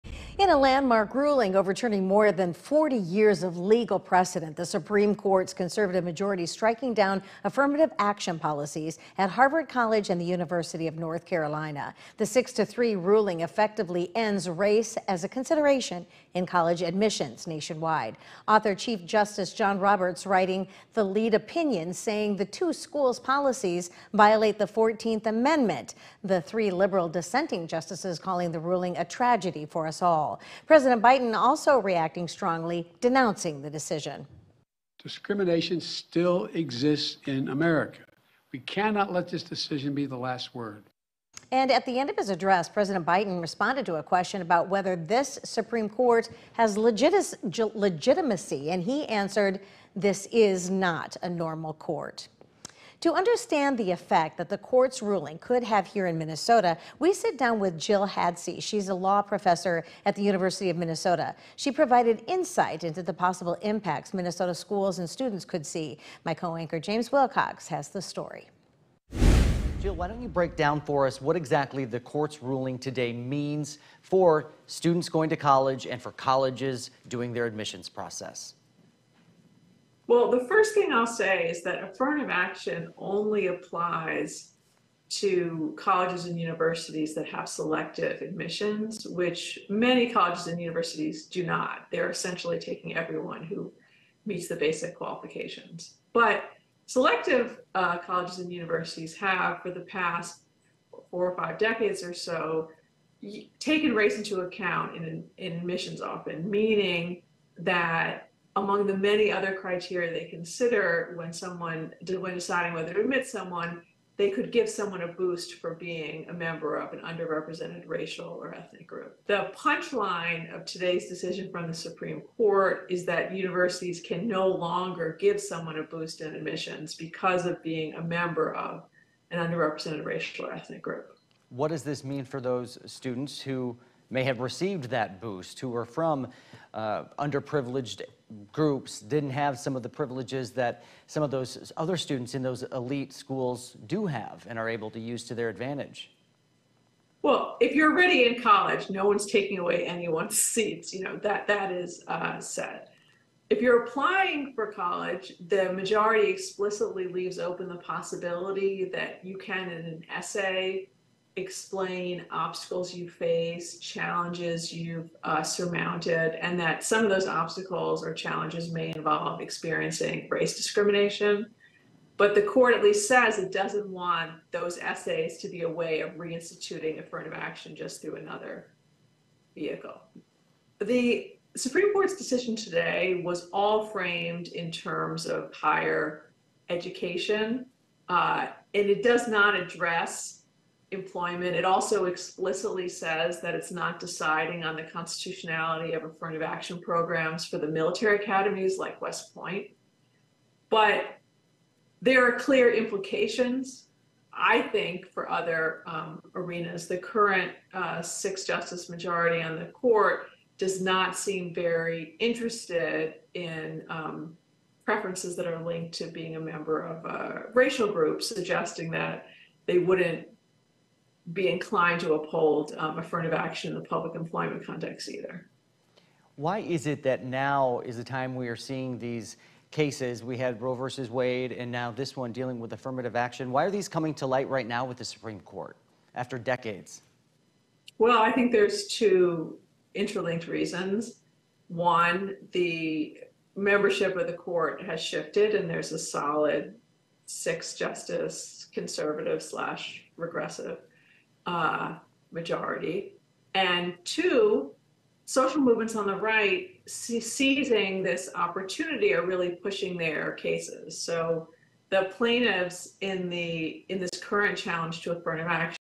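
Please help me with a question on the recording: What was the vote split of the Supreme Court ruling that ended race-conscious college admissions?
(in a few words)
6 to 3.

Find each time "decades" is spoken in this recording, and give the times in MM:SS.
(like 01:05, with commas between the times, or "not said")
01:41, 03:56.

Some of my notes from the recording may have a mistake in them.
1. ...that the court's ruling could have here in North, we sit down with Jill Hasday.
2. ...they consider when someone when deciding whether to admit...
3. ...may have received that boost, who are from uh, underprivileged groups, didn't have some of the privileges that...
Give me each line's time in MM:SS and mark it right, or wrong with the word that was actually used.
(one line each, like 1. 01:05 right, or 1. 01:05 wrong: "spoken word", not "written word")
1. 00:54 wrong: "Minnesota", not "North"
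2. 01:50 right
3. 02:14 right.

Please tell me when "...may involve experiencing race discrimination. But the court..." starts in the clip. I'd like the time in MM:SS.
02:48.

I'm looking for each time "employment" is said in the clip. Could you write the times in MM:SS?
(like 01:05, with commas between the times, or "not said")
03:10, 03:44.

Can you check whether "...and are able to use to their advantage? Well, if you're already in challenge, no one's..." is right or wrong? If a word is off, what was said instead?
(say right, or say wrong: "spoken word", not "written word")
wrong: "college", not "challenge".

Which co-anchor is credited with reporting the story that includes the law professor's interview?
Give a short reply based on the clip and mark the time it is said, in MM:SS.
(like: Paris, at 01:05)
James Wilcox, at 01:06.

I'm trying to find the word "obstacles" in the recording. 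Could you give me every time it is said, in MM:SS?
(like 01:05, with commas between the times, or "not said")
02:42, 02:47.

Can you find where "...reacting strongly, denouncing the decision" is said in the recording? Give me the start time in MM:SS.
00:31.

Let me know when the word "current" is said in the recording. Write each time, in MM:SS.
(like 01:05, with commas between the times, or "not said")
03:26, 04:24.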